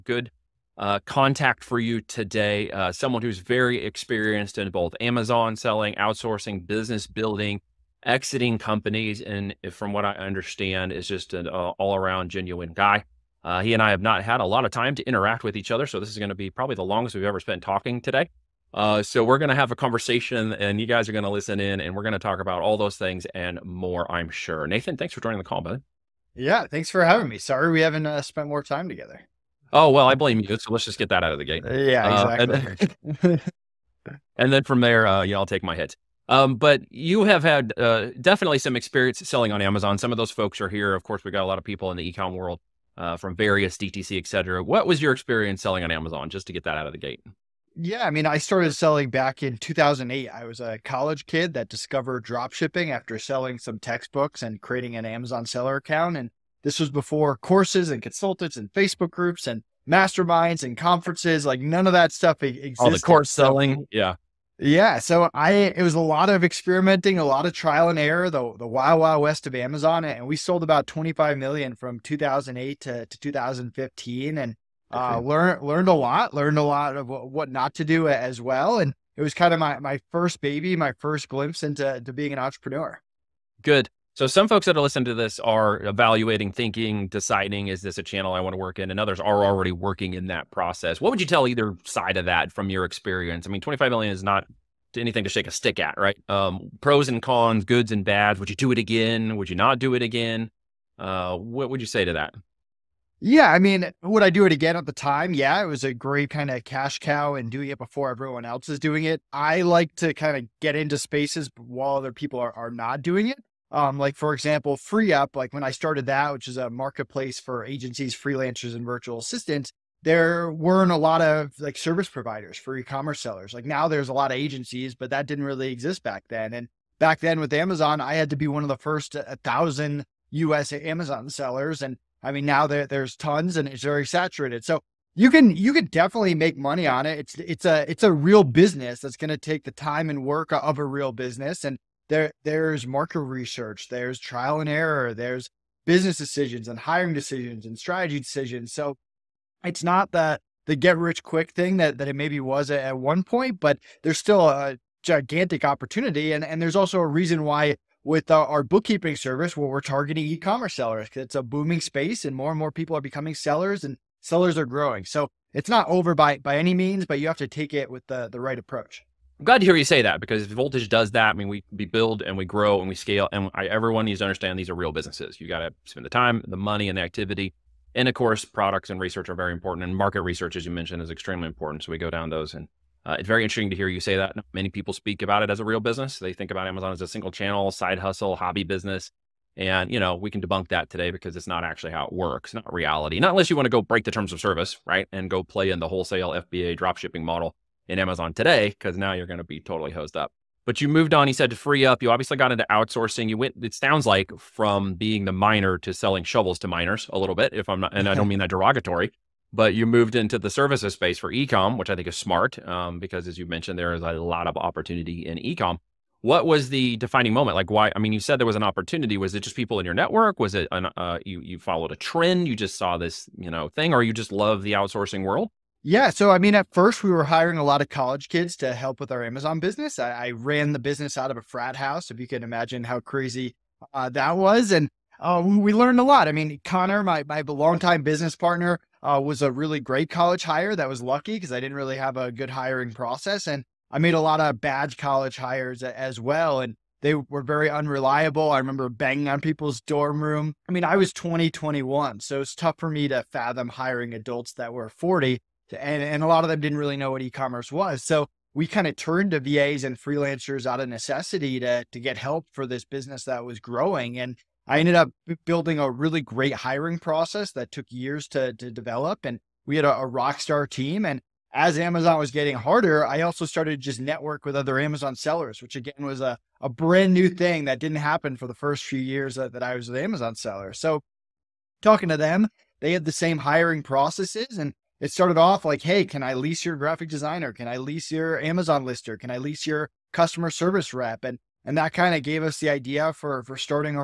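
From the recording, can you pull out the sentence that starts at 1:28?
And others are already working in that process.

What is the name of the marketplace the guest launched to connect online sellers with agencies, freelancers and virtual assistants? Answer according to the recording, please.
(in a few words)
FreeUp.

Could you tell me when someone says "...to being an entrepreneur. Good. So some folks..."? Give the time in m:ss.
1:22.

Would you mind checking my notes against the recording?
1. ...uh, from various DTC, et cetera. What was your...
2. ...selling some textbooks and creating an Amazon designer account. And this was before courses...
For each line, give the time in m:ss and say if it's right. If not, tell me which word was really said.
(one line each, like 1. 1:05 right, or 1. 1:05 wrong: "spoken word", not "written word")
1. 0:42 right
2. 0:53 wrong: "seller", not "designer".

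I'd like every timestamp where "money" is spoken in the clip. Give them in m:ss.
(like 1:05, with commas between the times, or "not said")
2:16, 2:56.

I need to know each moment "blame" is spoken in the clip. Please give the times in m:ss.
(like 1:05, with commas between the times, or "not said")
0:30.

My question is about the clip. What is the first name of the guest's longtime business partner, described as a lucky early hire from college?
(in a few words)
Connor.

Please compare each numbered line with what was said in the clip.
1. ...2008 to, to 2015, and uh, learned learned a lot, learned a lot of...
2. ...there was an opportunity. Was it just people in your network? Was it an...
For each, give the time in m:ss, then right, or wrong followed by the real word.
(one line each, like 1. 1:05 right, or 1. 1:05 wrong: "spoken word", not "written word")
1. 1:11 right
2. 3:38 right.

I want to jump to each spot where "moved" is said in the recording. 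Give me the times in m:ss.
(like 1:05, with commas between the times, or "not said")
3:20, 3:29.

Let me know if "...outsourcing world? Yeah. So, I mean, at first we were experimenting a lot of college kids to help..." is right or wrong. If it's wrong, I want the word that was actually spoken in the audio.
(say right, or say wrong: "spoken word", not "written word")
wrong: "hiring", not "experimenting".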